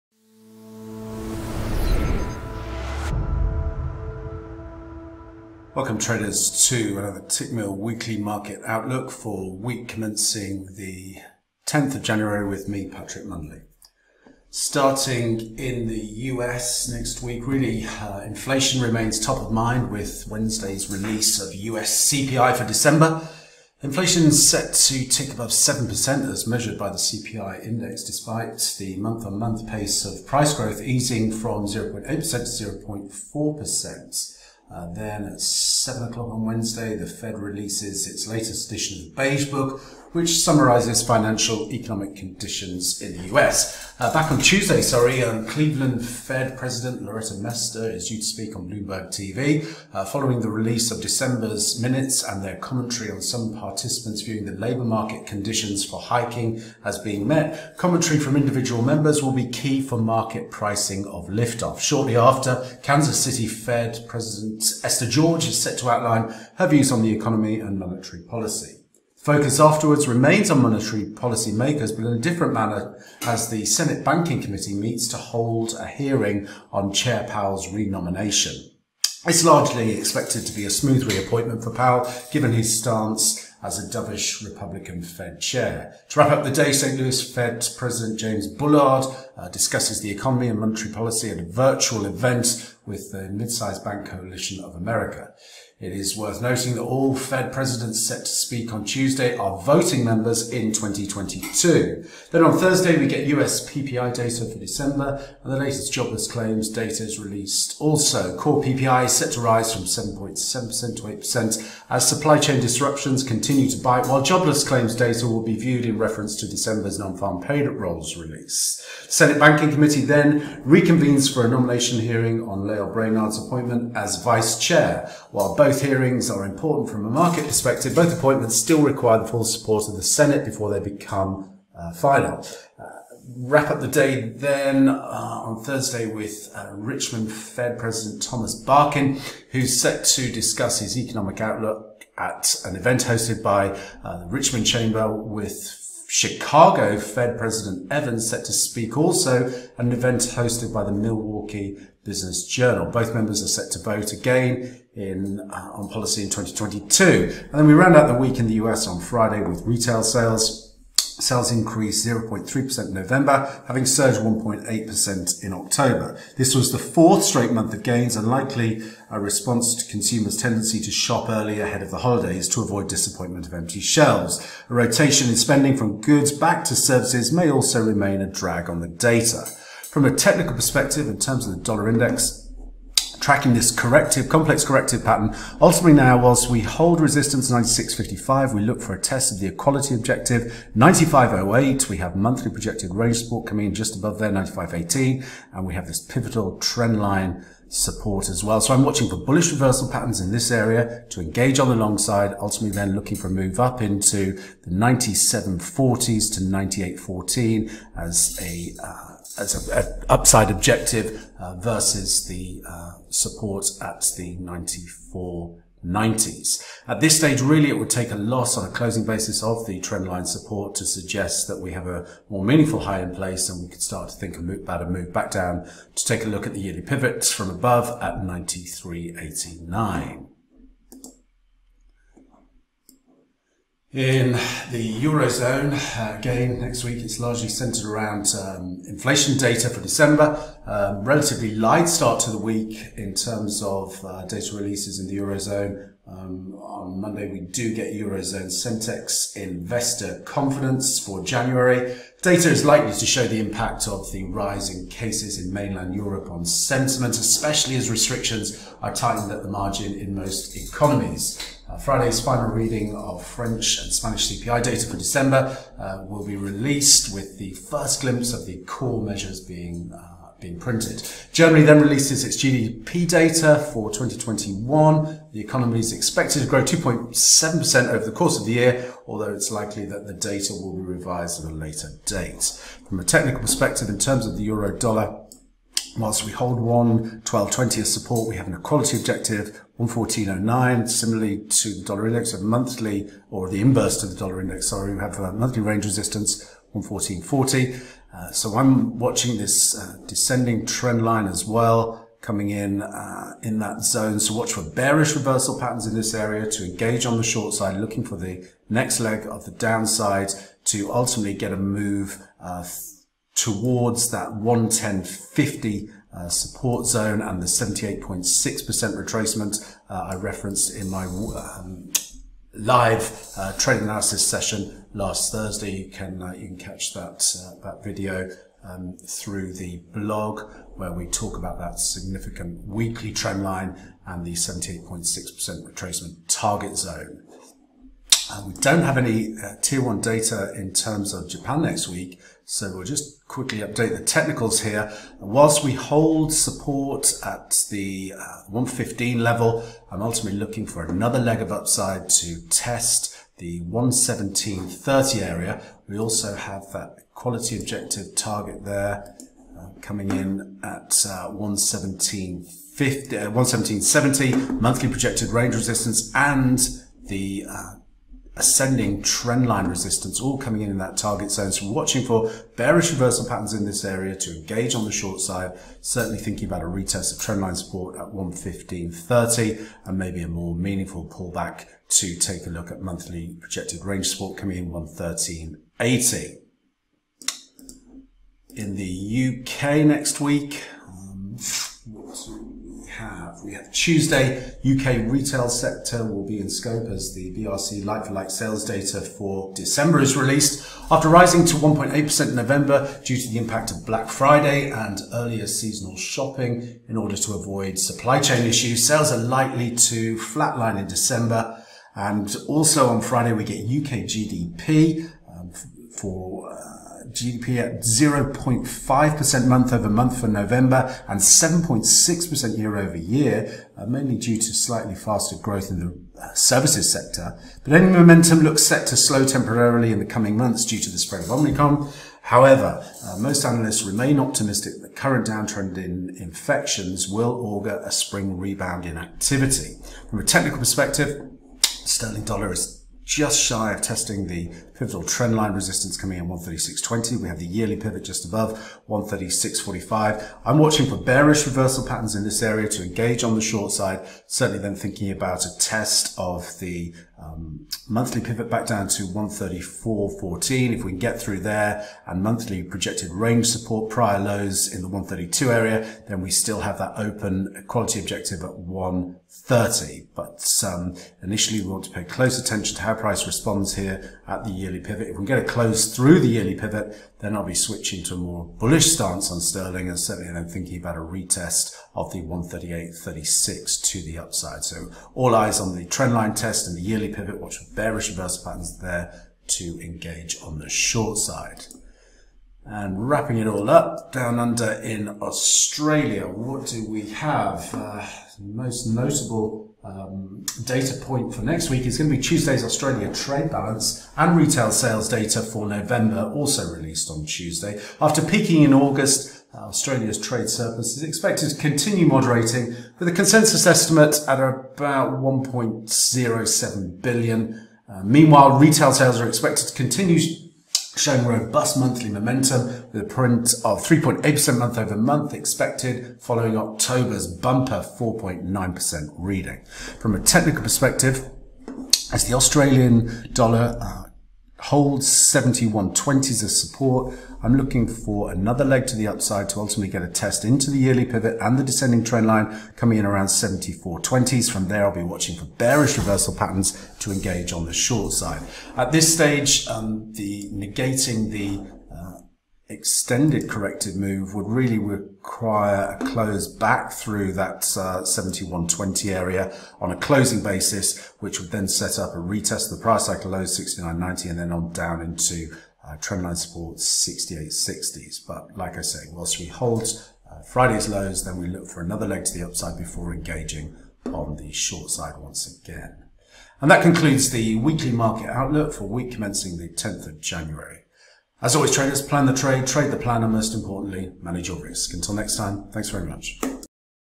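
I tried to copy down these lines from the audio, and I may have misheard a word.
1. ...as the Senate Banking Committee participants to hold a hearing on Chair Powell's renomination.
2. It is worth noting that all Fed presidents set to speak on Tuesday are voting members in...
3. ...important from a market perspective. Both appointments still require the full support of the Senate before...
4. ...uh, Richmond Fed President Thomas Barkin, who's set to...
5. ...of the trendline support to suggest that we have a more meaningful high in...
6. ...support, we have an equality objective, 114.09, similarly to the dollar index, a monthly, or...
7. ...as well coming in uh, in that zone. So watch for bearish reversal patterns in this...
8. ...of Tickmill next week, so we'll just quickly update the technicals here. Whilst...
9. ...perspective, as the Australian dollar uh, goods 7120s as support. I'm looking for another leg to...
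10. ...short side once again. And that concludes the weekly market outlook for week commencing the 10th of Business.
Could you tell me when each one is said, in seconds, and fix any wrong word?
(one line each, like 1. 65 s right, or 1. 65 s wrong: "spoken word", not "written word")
1. 73 s wrong: "meets", not "participants"
2. 95 s right
3. 126 s right
4. 136 s right
5. 219 s right
6. 287 s right
7. 301 s right
8. 341 s wrong: "Japan", not "Tickmill"
9. 530 s wrong: "holds", not "goods"
10. 574 s wrong: "January", not "Business".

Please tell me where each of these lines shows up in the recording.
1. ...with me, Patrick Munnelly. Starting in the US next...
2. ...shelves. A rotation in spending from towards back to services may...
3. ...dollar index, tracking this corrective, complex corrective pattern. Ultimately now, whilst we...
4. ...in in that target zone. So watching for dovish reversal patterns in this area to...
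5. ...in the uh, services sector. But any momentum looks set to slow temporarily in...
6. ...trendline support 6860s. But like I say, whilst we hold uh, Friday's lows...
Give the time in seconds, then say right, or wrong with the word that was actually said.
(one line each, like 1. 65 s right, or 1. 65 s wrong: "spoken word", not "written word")
1. 12 s right
2. 173 s wrong: "goods", not "towards"
3. 181 s right
4. 370 s wrong: "bearish", not "dovish"
5. 425 s right
6. 565 s right.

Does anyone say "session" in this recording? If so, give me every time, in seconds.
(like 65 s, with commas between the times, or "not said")
324 s.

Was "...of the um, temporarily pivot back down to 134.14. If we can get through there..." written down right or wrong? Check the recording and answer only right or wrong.
wrong.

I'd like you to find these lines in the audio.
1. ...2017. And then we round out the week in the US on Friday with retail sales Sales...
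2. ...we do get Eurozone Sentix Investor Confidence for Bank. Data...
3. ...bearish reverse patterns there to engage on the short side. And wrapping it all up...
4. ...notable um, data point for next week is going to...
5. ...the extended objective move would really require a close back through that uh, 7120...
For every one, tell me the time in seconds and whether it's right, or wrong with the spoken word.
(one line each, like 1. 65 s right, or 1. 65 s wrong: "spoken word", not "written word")
1. 156 s wrong: "2022", not "2017"
2. 247 s wrong: "January", not "Bank"
3. 487 s right
4. 498 s right
5. 551 s wrong: "corrective", not "objective".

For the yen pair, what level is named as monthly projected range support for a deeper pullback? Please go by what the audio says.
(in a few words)
113.80.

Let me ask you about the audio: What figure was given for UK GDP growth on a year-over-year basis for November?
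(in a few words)
7.6%.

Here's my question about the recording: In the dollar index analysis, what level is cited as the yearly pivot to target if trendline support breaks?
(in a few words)
93.89.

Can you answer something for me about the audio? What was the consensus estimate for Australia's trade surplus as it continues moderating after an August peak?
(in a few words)
1.07 billion.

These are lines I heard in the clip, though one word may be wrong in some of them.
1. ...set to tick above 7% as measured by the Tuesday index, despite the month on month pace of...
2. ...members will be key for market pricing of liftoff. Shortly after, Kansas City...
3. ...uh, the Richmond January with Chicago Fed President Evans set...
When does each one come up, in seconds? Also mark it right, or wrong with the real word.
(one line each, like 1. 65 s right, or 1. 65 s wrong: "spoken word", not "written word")
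1. 24 s wrong: "CPI", not "Tuesday"
2. 58 s right
3. 144 s wrong: "Chamber", not "January".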